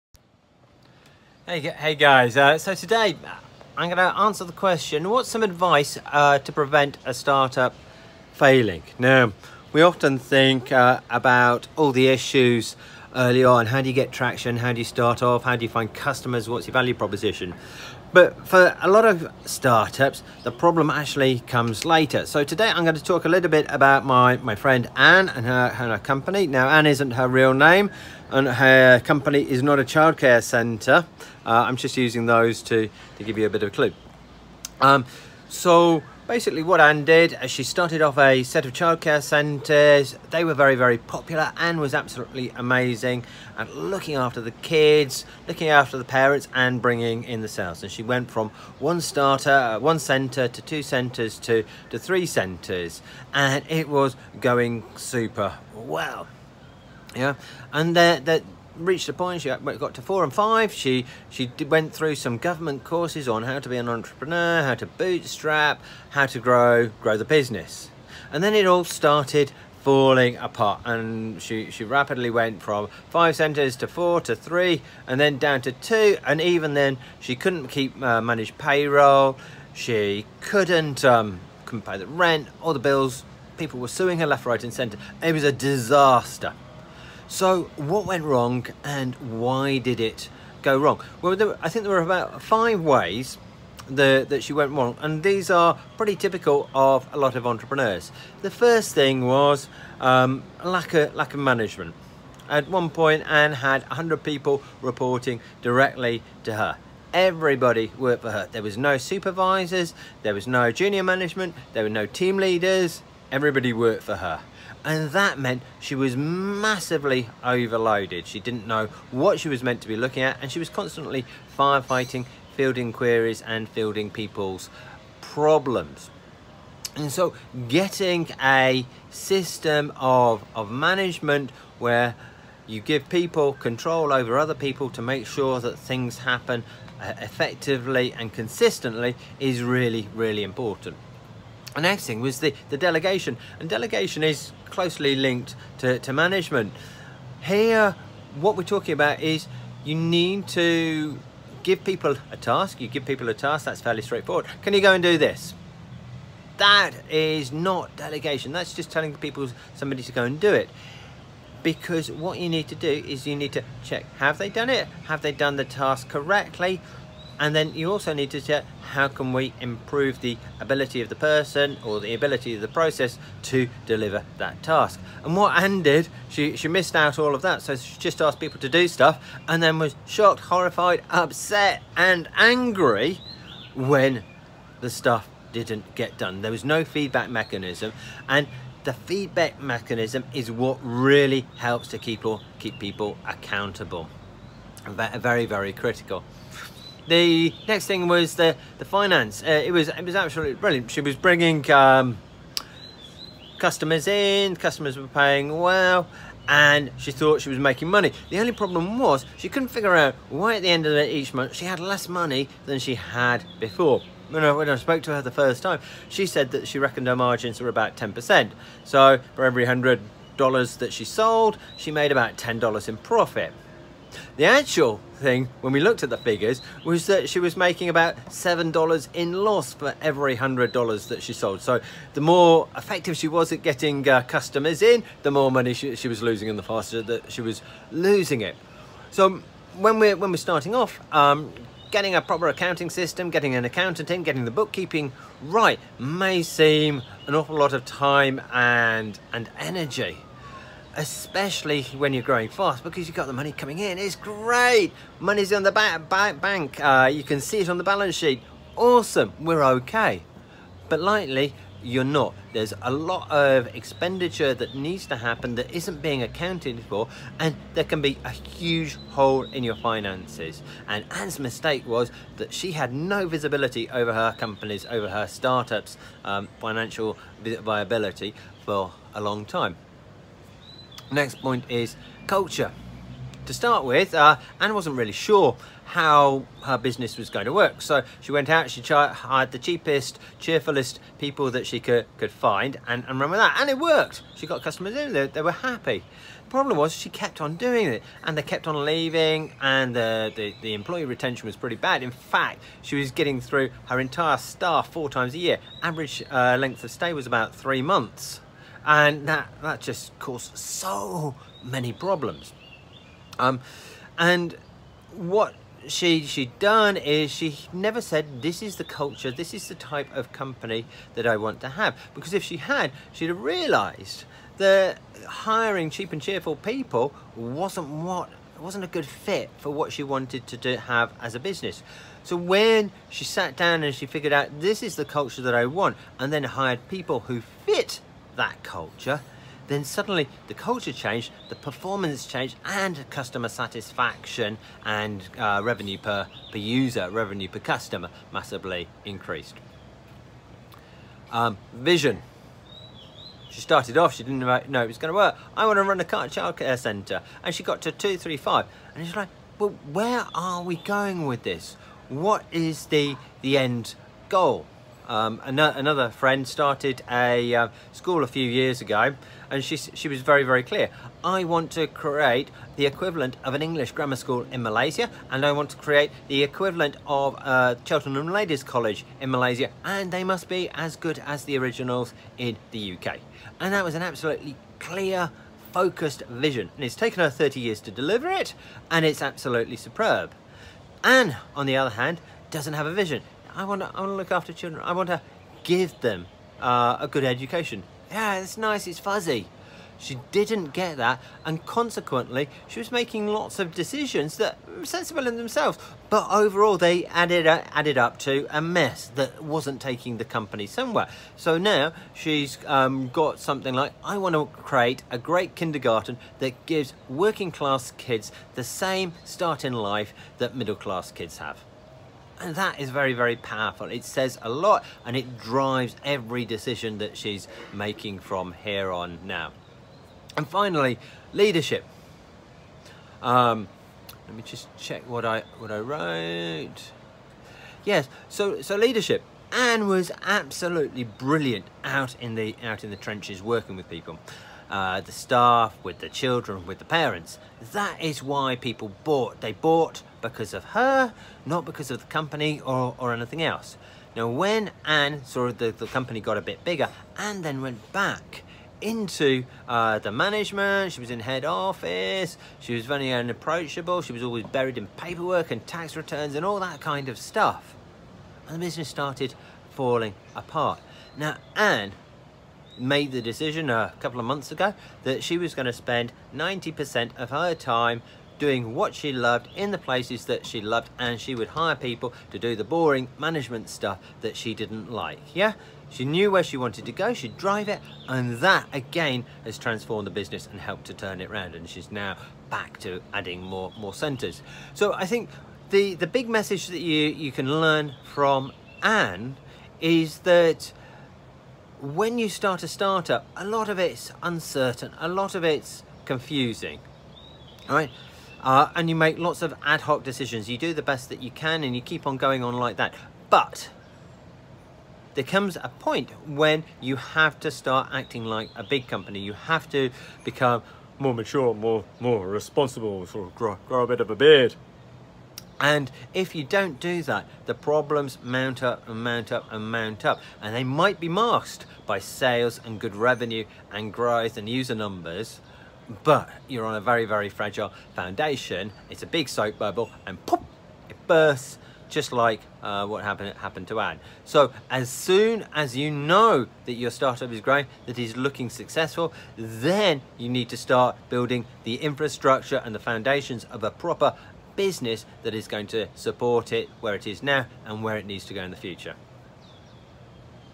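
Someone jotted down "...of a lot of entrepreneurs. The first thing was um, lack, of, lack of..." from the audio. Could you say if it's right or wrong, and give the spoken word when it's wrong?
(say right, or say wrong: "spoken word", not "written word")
right.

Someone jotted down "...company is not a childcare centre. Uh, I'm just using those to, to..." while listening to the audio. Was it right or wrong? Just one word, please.
right.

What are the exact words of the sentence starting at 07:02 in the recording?
And that is very, very powerful.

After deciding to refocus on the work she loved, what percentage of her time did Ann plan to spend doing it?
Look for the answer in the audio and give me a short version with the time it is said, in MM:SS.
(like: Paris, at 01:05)
90%, at 07:56.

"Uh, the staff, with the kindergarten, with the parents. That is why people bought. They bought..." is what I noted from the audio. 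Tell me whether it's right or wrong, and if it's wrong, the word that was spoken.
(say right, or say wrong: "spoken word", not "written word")
wrong: "children", not "kindergarten".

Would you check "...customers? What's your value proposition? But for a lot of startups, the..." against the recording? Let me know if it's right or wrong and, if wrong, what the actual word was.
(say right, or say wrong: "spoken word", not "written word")
right.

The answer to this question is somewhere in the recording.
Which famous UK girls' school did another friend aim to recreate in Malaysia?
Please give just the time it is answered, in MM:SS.
06:17.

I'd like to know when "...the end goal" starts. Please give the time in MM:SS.
06:03.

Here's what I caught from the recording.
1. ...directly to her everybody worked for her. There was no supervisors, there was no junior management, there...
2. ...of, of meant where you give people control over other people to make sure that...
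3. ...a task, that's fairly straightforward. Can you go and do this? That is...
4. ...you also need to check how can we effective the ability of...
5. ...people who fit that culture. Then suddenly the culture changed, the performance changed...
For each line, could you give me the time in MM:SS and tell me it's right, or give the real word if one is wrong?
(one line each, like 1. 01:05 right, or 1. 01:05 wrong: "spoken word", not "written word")
1. 01:45 right
2. 02:09 wrong: "management", not "meant"
3. 02:33 right
4. 02:47 wrong: "improve", not "effective"
5. 05:36 right.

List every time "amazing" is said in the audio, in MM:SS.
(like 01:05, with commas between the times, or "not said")
00:42.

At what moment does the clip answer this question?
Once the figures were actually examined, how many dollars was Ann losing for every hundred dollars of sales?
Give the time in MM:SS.
03:48.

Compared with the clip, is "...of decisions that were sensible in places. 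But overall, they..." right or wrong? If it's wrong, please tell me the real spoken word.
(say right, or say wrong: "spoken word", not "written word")
wrong: "themselves", not "places".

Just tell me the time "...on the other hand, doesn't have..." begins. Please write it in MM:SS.
06:31.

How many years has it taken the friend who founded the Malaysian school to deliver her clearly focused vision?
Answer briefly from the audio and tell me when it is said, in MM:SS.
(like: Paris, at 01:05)
30 years, at 06:27.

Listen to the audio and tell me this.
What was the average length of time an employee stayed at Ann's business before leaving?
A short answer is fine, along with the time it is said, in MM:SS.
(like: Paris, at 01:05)
Three months, at 05:07.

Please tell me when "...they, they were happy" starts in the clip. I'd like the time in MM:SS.
04:55.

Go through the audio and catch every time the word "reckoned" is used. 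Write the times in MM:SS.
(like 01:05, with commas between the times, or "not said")
03:36.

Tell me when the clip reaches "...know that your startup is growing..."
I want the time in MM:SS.
09:05.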